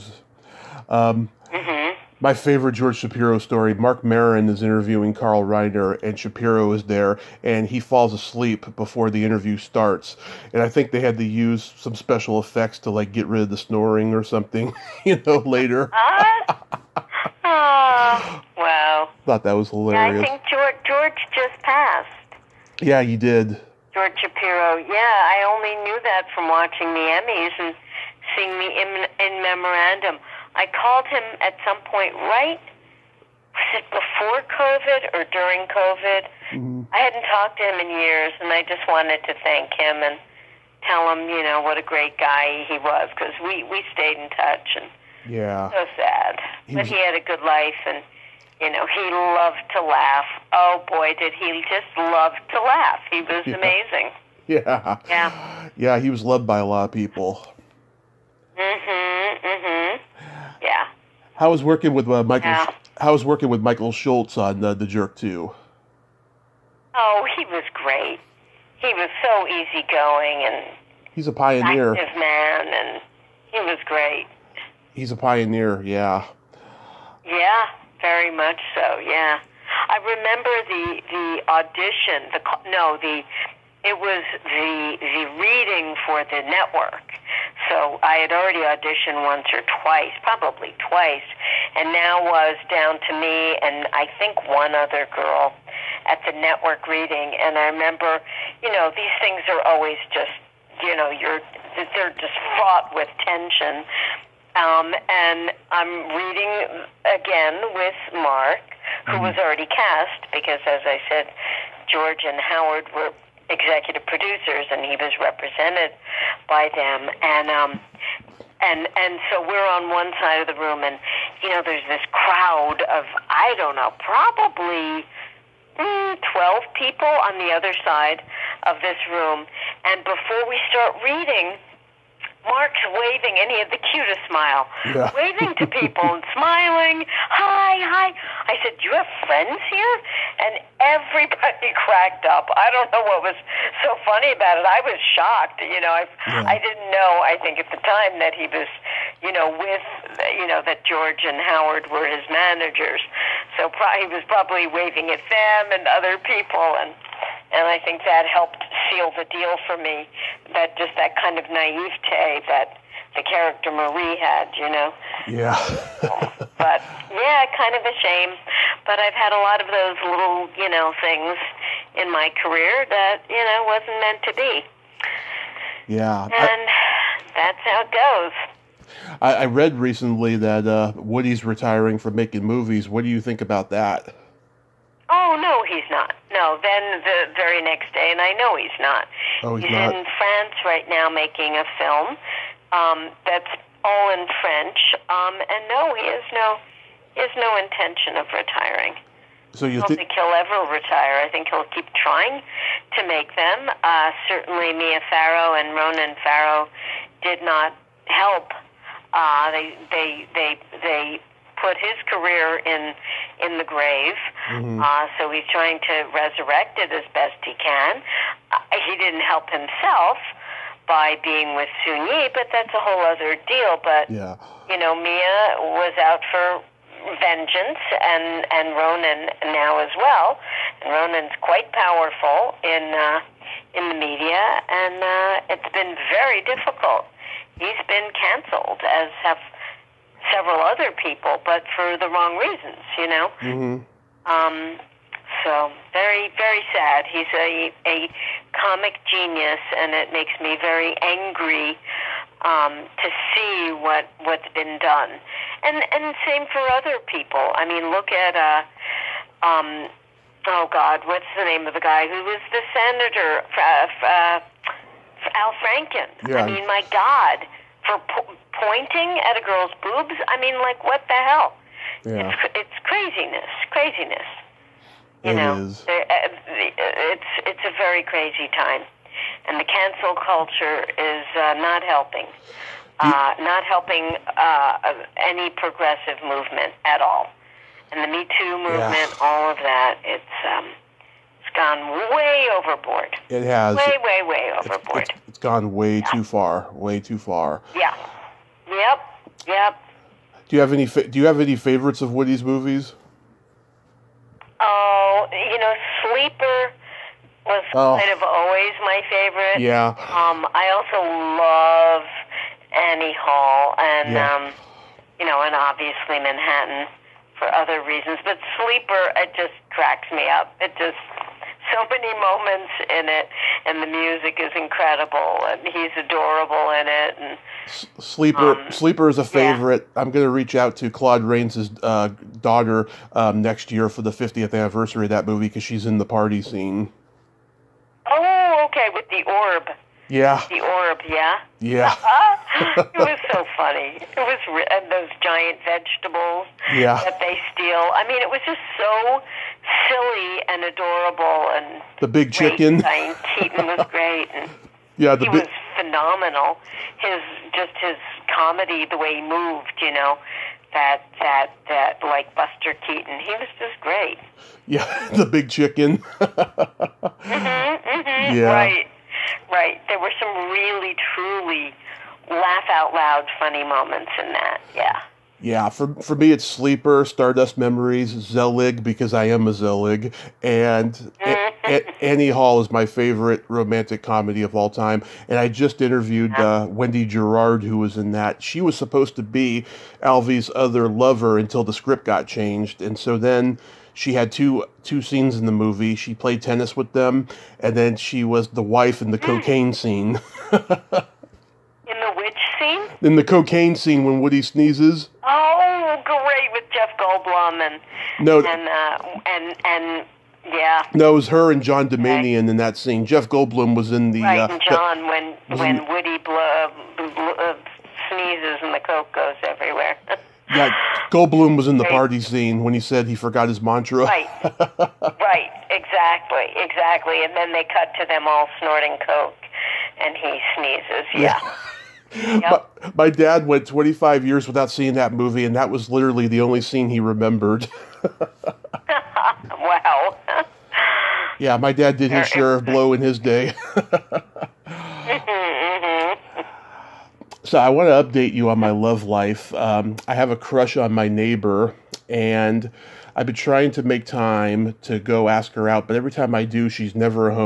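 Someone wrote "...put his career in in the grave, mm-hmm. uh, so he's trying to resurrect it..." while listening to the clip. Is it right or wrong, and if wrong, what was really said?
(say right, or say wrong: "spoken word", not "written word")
right.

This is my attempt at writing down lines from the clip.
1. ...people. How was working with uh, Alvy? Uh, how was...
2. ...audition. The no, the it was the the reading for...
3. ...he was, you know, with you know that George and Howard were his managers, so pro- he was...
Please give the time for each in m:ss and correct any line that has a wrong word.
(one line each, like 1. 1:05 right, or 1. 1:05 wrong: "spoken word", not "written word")
1. 0:56 wrong: "Michael", not "Alvy"
2. 1:21 right
3. 2:28 right.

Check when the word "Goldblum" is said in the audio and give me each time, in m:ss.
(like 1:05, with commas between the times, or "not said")
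6:46, 6:53, 7:01.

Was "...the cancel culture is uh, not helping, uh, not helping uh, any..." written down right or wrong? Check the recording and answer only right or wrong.
right.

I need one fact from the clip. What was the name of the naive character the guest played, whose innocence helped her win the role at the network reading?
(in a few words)
Marie.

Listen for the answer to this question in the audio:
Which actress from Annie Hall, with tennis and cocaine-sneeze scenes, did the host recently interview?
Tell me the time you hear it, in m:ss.
6:26.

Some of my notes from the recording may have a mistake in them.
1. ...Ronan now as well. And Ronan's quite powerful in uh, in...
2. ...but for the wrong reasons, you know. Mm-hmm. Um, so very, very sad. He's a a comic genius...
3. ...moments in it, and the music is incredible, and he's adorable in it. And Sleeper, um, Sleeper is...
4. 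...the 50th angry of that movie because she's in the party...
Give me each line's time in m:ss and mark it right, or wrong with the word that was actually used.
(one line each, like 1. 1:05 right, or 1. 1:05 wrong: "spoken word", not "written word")
1. 3:48 right
2. 4:01 right
3. 5:22 right
4. 5:34 wrong: "anniversary", not "angry".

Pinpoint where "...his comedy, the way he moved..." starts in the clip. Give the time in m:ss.
5:57.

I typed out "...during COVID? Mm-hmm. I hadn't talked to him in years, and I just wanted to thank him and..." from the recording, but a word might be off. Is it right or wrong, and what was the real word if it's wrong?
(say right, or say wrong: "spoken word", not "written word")
right.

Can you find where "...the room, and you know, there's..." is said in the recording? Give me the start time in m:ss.
2:00.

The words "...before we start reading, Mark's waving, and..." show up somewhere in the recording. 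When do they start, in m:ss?
2:10.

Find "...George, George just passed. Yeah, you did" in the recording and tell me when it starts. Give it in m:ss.
0:20.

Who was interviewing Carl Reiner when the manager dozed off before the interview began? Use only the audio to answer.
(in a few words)
Marc Maron.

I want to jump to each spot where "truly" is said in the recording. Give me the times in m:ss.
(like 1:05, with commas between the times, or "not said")
6:11.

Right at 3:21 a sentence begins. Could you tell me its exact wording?
I think he'll keep trying to make them.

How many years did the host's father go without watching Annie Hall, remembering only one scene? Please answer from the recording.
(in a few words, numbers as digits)
25.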